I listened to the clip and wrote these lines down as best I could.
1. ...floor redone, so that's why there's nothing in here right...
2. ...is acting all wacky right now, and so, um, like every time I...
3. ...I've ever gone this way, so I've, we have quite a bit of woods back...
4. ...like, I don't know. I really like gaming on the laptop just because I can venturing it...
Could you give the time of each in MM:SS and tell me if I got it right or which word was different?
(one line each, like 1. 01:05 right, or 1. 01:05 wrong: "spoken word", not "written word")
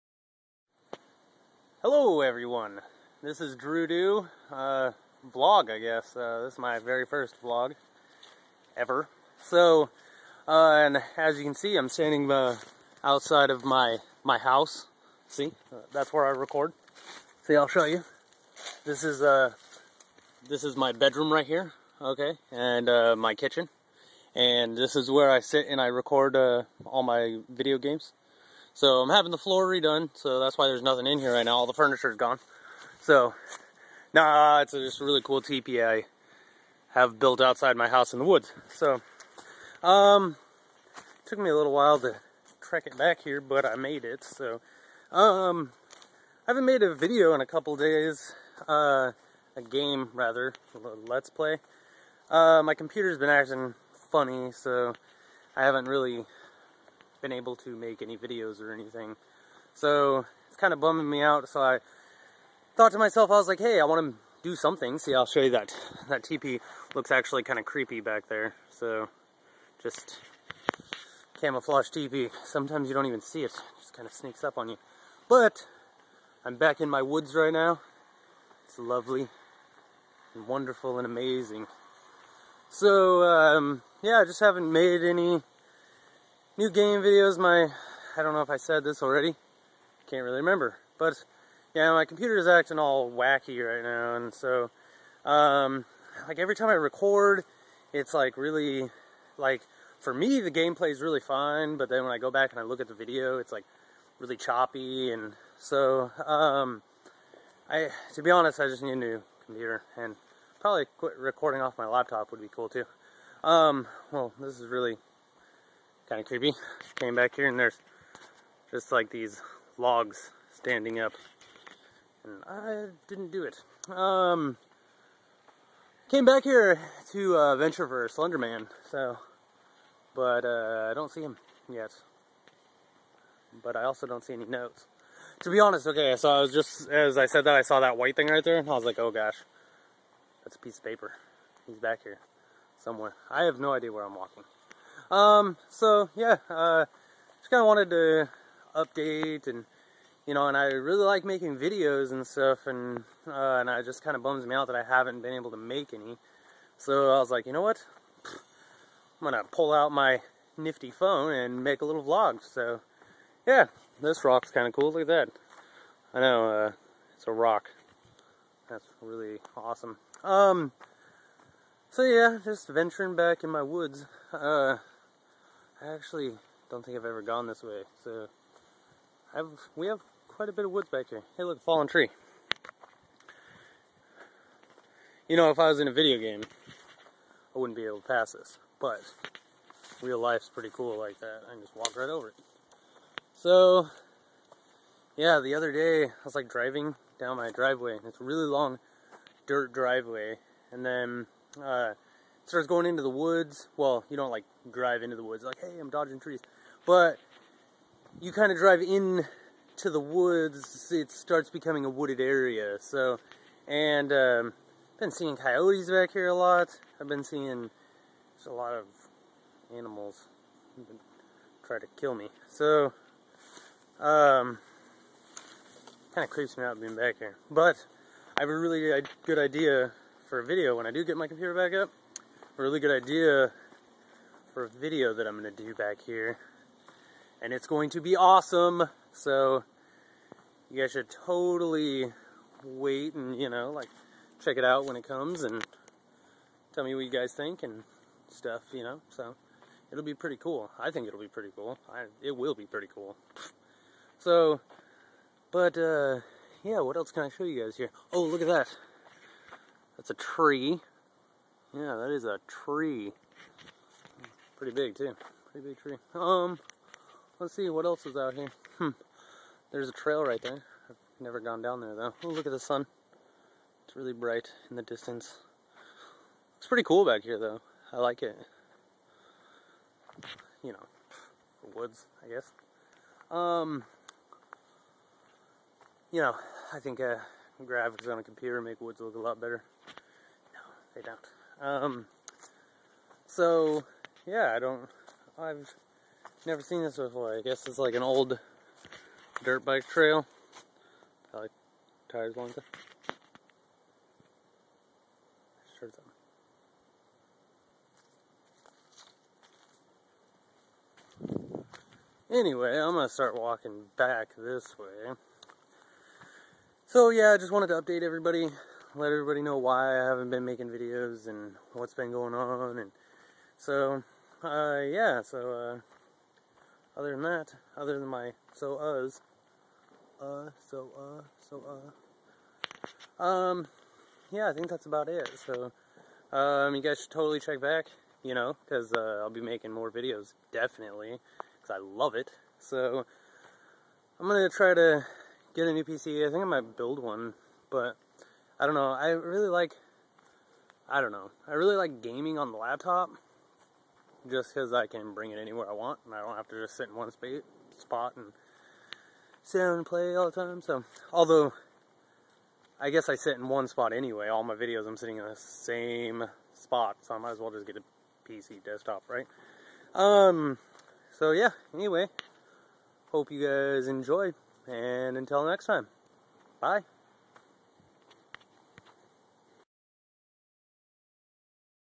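1. 00:29 right
2. 01:32 right
3. 02:56 right
4. 05:49 wrong: "bring", not "venturing".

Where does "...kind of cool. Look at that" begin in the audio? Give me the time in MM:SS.
02:44.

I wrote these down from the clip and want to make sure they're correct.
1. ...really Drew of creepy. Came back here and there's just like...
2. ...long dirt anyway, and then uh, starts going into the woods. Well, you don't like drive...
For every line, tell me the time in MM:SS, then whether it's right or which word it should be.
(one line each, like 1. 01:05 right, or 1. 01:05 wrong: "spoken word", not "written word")
1. 01:54 wrong: "Kind", not "Drew"
2. 03:18 wrong: "driveway", not "anyway".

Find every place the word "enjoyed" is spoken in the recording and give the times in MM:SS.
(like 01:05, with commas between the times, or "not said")
06:13.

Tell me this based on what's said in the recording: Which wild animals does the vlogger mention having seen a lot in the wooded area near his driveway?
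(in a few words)
Coyotes.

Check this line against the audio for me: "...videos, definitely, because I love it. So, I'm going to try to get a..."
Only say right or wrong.
right.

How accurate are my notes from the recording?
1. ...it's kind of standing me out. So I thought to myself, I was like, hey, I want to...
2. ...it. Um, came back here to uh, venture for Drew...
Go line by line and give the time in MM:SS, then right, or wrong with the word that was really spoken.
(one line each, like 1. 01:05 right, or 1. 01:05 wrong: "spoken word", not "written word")
1. 01:00 wrong: "bumming", not "standing"
2. 02:03 wrong: "Slenderman", not "Drew".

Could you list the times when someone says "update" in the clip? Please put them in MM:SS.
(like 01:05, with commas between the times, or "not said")
02:28, 05:17.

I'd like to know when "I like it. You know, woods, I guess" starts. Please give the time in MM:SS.
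04:37.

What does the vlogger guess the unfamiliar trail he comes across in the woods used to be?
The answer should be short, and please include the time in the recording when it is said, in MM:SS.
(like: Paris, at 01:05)
An old dirt bike trail, at 04:58.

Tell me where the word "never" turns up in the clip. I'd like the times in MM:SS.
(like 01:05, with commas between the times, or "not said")
04:31, 04:56.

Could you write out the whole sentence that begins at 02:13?
But I also don't see any notes.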